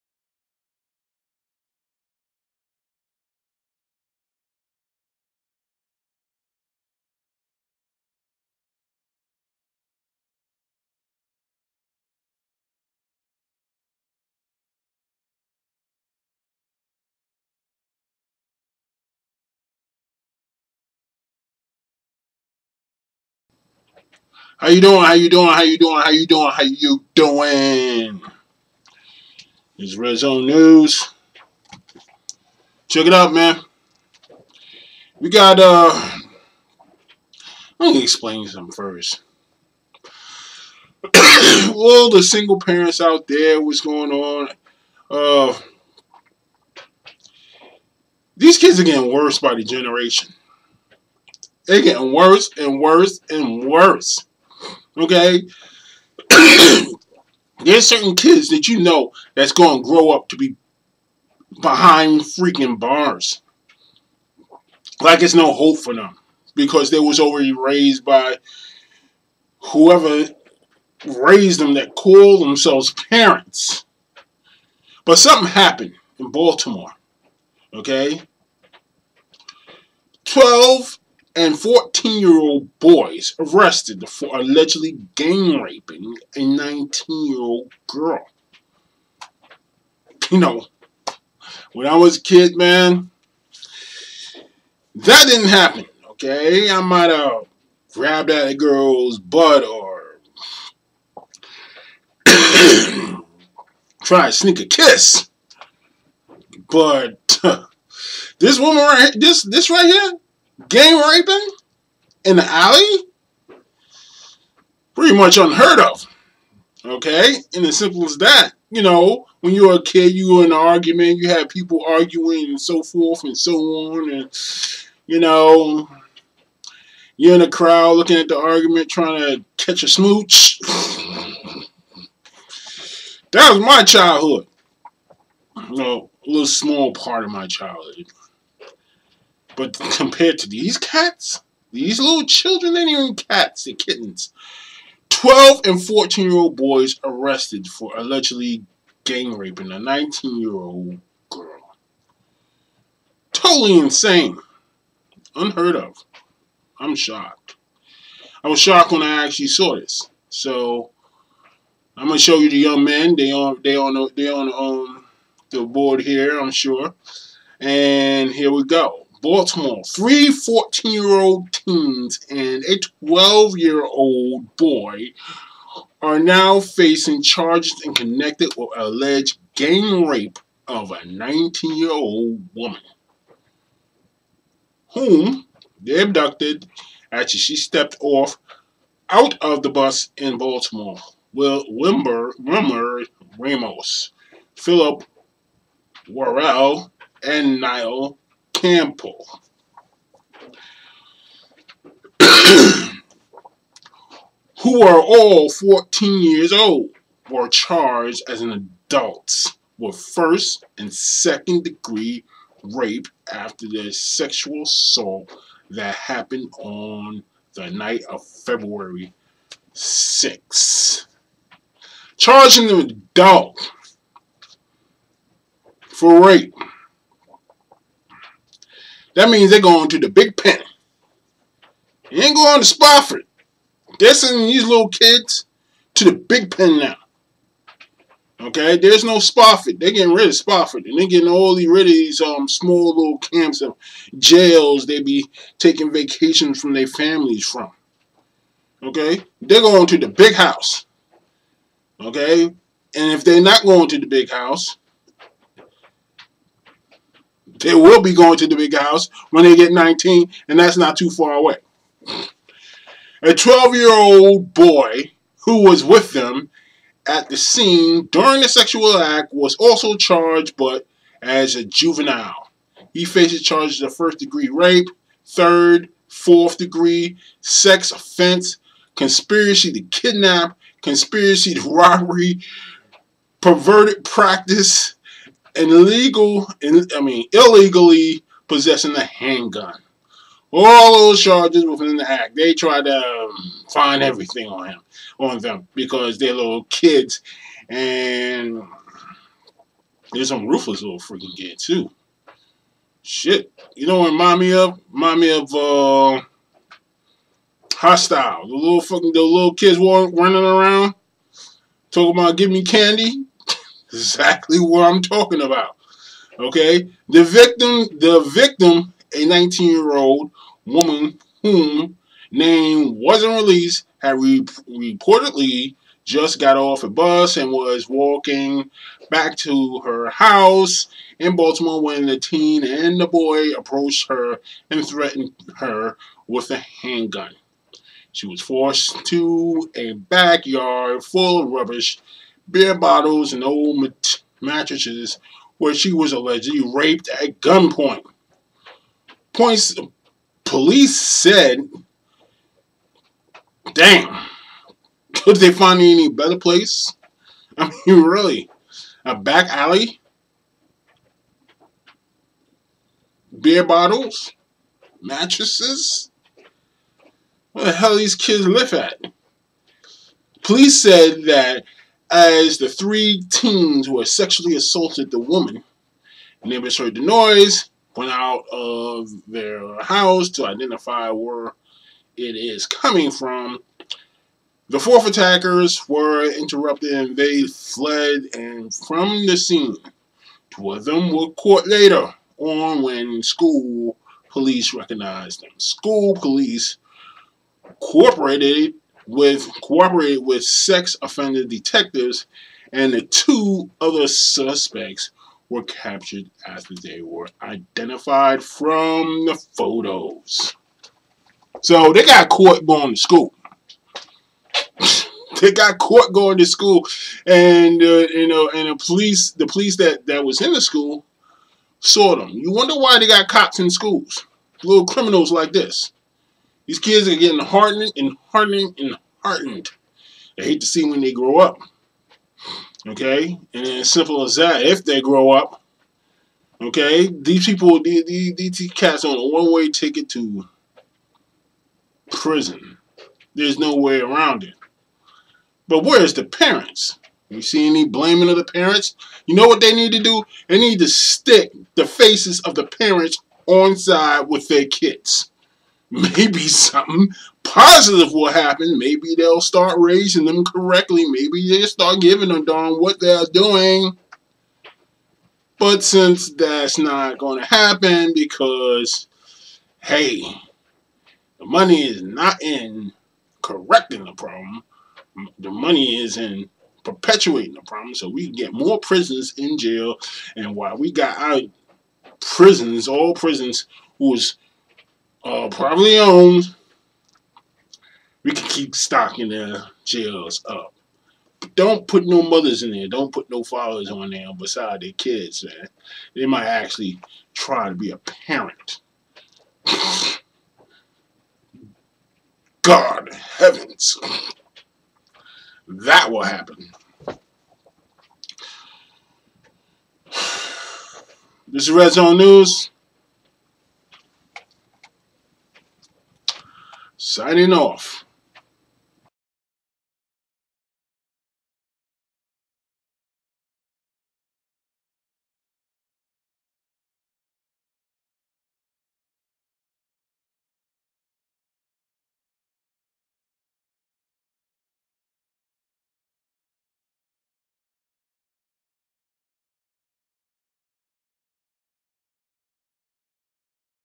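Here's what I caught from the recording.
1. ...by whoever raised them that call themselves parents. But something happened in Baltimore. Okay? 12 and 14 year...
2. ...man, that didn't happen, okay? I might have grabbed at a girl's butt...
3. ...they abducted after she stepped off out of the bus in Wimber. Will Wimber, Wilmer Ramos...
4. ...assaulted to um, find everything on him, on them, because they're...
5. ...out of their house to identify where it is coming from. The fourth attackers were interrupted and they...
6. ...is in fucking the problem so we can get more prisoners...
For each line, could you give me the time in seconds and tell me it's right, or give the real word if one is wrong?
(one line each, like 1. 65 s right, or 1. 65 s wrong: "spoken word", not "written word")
1. 68 s right
2. 92 s right
3. 185 s wrong: "Baltimore", not "Wimber"
4. 292 s wrong: "tried", not "assaulted"
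5. 378 s right
6. 476 s wrong: "perpetuating", not "fucking".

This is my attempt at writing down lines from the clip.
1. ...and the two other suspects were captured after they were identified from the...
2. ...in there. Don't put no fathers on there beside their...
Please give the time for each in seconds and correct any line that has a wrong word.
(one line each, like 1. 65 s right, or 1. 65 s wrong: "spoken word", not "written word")
1. 402 s right
2. 492 s right.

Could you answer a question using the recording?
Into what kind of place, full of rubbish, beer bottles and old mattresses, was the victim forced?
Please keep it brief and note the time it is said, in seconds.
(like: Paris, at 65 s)
A backyard, at 339 s.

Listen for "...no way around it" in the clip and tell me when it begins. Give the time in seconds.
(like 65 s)
443 s.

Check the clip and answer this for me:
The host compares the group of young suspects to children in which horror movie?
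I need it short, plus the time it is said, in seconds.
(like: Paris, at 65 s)
Hostel, at 307 s.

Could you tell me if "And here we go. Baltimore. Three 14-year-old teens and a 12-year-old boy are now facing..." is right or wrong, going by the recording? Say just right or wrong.
right.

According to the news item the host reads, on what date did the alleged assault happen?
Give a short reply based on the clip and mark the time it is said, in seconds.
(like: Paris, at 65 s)
February 6, at 218 s.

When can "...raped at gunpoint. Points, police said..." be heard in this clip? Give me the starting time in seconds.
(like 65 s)
346 s.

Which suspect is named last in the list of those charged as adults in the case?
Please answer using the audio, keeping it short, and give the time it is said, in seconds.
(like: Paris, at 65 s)
Nile Campbell, at 197 s.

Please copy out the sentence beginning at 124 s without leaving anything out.
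And, you know, you're in a crowd looking at the argument, trying to catch a smooch.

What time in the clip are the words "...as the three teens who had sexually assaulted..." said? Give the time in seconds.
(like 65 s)
372 s.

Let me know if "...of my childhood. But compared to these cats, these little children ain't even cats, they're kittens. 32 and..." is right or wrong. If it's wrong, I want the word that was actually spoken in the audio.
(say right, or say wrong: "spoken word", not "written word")
wrong: "12", not "32".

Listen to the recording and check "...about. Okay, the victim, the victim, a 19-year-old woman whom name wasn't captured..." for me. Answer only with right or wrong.
wrong.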